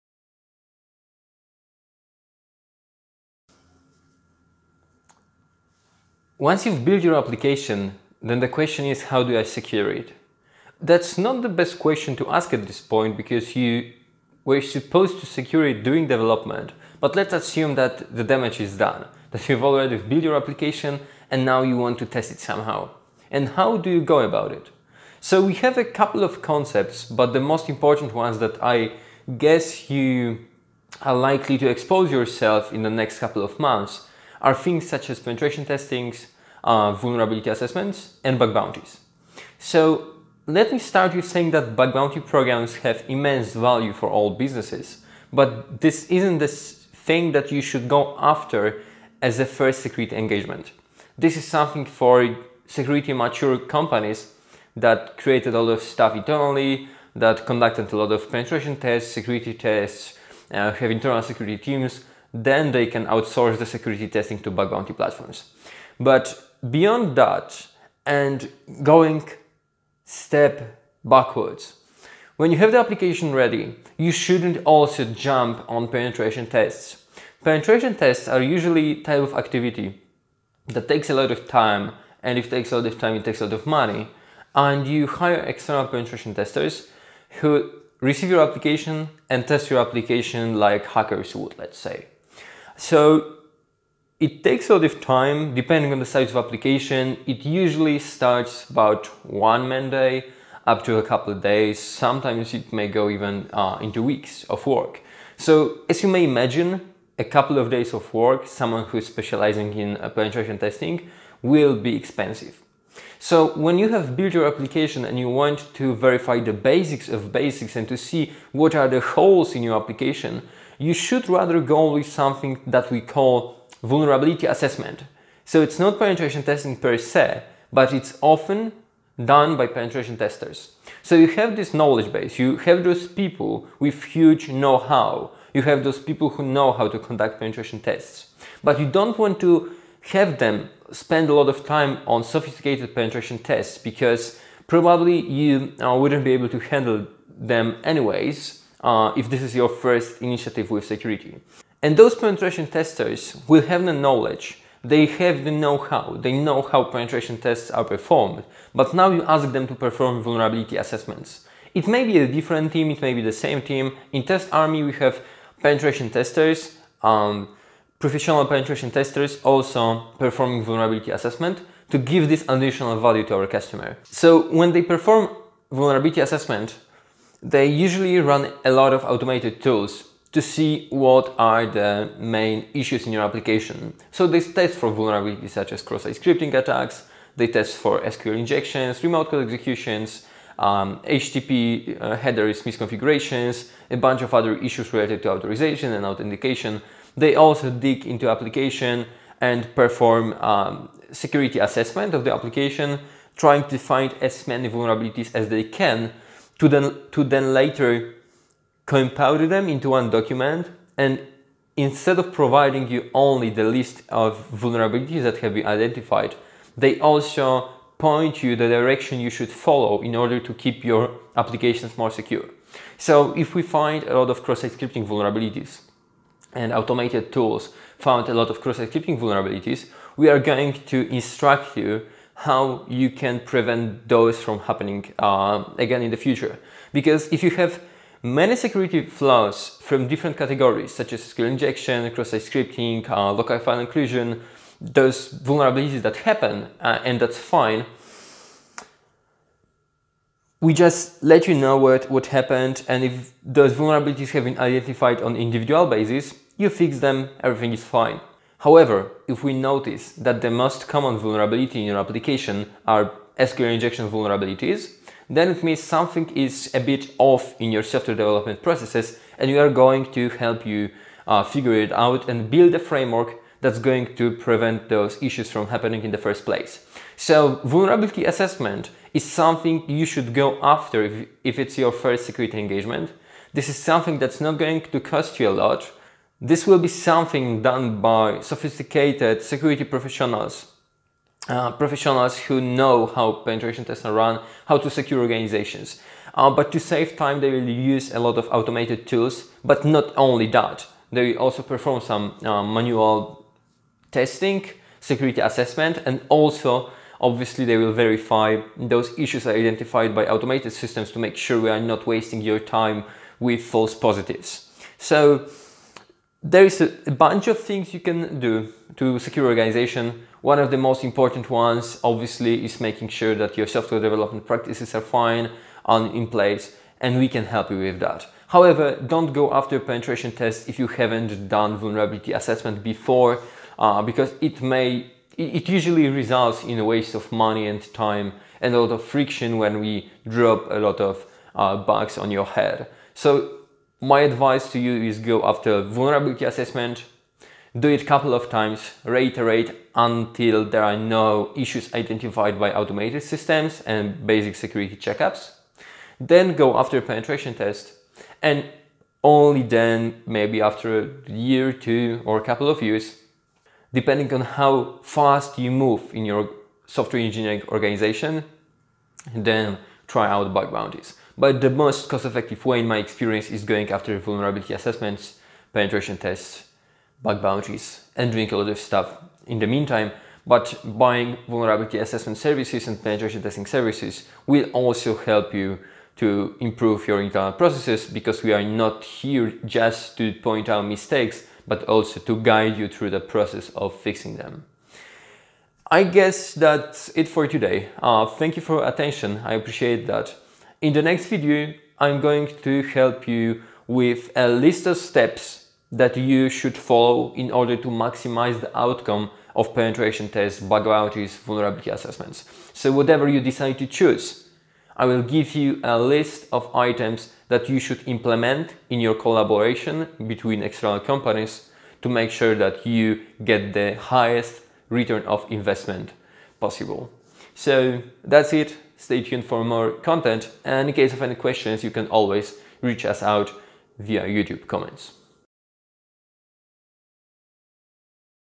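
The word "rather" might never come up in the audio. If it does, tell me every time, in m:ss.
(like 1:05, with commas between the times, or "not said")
2:01.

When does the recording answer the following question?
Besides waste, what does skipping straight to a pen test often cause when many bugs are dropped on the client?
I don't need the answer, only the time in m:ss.
5:39.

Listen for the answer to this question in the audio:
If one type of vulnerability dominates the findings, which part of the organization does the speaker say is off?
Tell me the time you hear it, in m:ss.
4:27.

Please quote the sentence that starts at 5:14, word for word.
So there is a bunch of things you can do to secure organization.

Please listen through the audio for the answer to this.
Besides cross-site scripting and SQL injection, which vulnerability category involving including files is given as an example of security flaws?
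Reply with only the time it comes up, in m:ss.
4:03.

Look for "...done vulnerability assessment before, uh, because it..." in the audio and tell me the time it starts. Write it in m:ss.
5:31.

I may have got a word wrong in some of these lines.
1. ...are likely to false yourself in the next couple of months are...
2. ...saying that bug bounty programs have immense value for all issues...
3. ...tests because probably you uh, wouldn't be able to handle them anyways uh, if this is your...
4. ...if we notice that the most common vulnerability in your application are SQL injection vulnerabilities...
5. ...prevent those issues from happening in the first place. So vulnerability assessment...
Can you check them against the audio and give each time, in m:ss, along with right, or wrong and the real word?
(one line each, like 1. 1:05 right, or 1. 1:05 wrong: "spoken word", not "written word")
1. 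0:31 wrong: "expose", not "false"
2. 0:41 wrong: "businesses", not "issues"
3. 2:23 right
4. 4:19 right
5. 4:34 right.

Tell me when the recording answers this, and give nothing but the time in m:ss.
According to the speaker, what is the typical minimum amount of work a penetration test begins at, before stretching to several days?
1:39.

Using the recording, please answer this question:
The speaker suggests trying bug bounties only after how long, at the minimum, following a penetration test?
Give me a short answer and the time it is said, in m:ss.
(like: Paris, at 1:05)
A year, at 6:01.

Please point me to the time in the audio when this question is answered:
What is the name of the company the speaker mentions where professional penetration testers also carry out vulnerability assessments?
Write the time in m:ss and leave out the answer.
2:44.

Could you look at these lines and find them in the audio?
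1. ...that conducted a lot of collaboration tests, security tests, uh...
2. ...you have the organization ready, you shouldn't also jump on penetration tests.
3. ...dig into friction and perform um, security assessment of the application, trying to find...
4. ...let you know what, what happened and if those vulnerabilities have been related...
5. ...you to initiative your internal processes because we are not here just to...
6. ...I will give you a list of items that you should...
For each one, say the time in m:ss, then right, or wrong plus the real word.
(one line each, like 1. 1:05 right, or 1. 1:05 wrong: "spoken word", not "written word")
1. 0:57 wrong: "penetration", not "collaboration"
2. 1:12 wrong: "application", not "organization"
3. 3:17 wrong: "application", not "friction"
4. 4:11 wrong: "identified", not "related"
5. 6:25 wrong: "improve", not "initiative"
6. 6:54 right.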